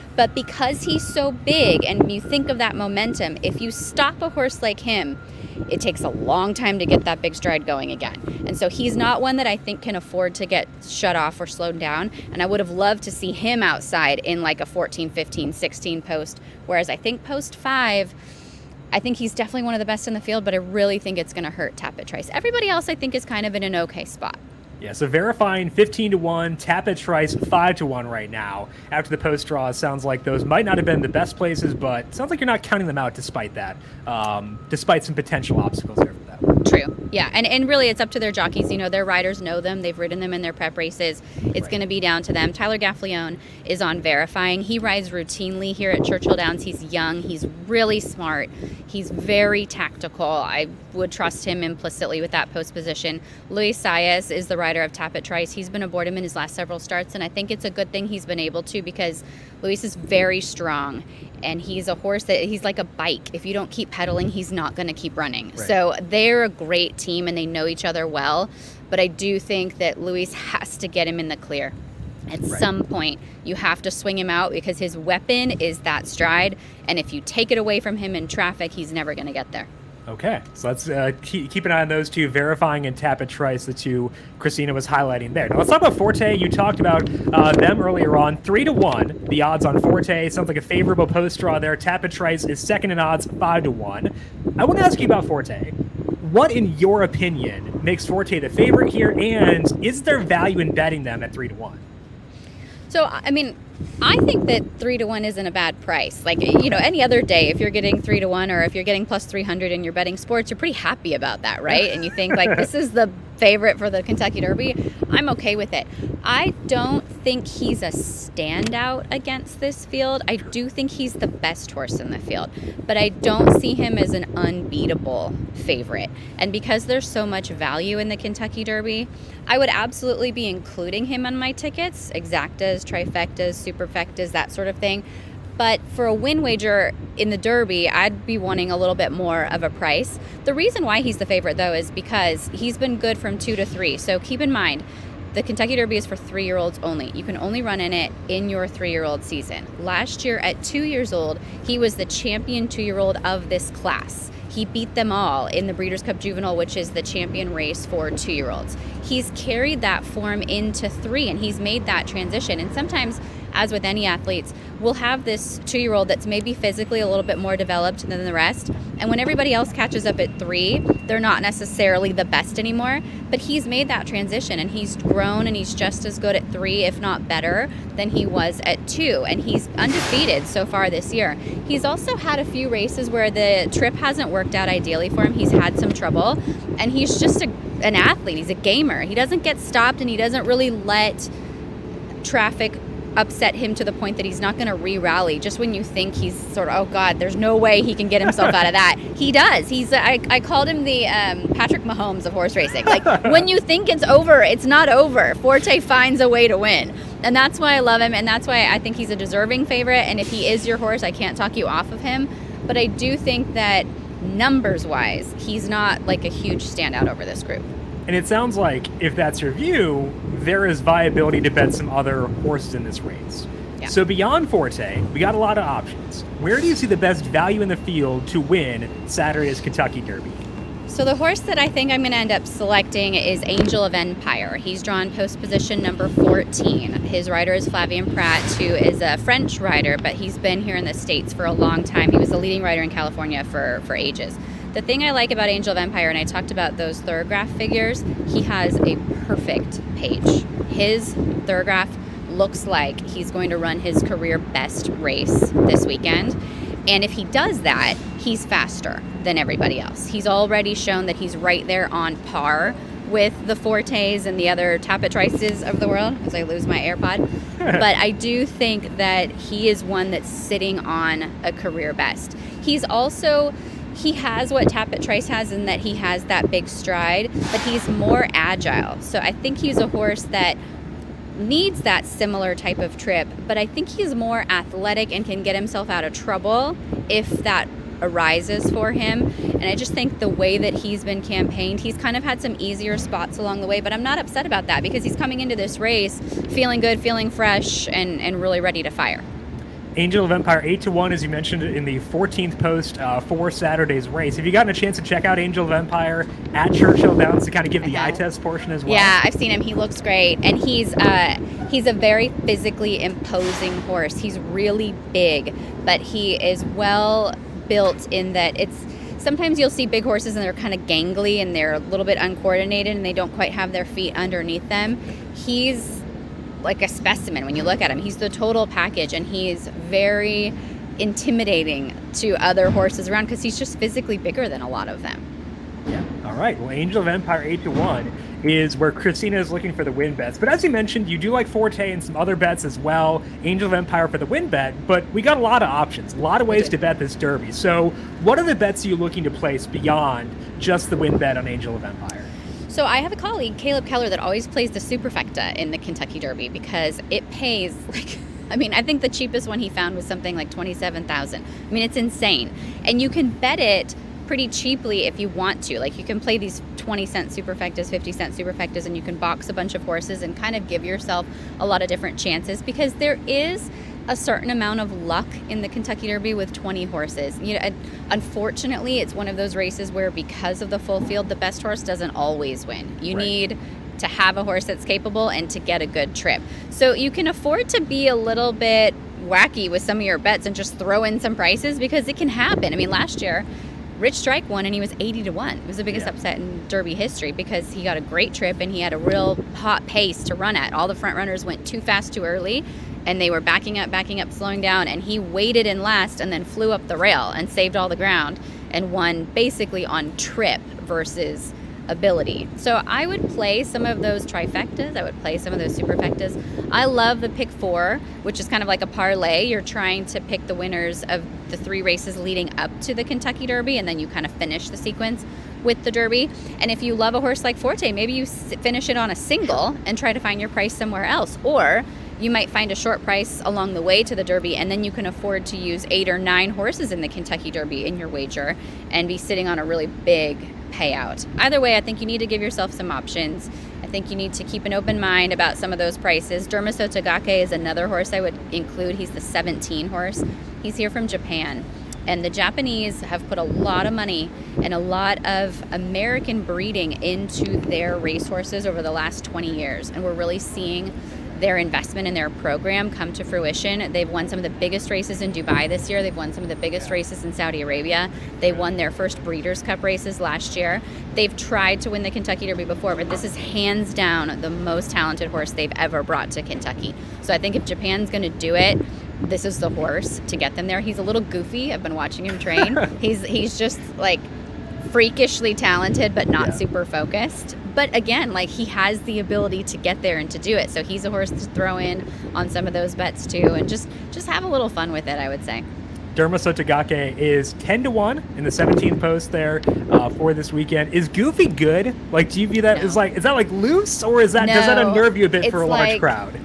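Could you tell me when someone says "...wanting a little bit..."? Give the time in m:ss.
2:18.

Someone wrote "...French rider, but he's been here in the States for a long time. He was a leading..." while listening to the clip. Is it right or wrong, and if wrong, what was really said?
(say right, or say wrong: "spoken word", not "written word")
right.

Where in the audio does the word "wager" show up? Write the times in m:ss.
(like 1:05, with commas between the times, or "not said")
2:16, 7:18.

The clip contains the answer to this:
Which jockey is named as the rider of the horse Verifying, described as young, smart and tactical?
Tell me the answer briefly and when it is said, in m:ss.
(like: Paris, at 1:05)
Tyler Gaffalione, at 0:42.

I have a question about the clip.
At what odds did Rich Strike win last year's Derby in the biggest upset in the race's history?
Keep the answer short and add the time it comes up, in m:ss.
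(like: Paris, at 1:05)
80 to 1, at 6:34.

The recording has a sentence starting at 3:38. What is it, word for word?
And it sounds like if that's your view, there is viability to bet some other horses in this race.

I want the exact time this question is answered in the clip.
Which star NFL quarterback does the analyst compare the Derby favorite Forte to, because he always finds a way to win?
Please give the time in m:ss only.
3:21.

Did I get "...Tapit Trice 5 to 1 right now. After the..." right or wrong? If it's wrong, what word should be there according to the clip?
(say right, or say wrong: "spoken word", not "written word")
right.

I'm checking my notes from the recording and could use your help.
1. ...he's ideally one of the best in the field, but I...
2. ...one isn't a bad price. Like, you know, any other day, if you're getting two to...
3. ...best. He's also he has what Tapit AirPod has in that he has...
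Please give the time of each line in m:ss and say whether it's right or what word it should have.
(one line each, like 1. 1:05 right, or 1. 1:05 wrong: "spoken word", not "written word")
1. 0:19 wrong: "definitely", not "ideally"
2. 1:45 wrong: "three", not "two"
3. 4:31 wrong: "Trice", not "AirPod".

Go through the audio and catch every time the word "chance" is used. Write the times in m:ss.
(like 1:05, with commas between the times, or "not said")
5:04, 6:12.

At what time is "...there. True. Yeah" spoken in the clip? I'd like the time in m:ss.
0:35.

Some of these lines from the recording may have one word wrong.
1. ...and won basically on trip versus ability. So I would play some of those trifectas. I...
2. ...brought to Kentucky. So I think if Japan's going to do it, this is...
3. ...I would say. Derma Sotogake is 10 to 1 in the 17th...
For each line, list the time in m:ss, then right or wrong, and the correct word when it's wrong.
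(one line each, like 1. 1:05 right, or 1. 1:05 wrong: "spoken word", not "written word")
1. 6:48 right
2. 7:56 right
3. 8:15 right.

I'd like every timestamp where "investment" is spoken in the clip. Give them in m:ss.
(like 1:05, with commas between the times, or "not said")
7:41.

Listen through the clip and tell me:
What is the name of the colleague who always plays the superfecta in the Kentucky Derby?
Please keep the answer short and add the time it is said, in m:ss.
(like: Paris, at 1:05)
Caleb Keller, at 5:53.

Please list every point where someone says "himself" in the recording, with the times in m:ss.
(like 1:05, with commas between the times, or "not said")
3:18, 4:45.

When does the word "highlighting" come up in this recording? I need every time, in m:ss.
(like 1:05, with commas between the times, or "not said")
1:24.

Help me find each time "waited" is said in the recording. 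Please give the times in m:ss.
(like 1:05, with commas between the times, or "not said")
6:45.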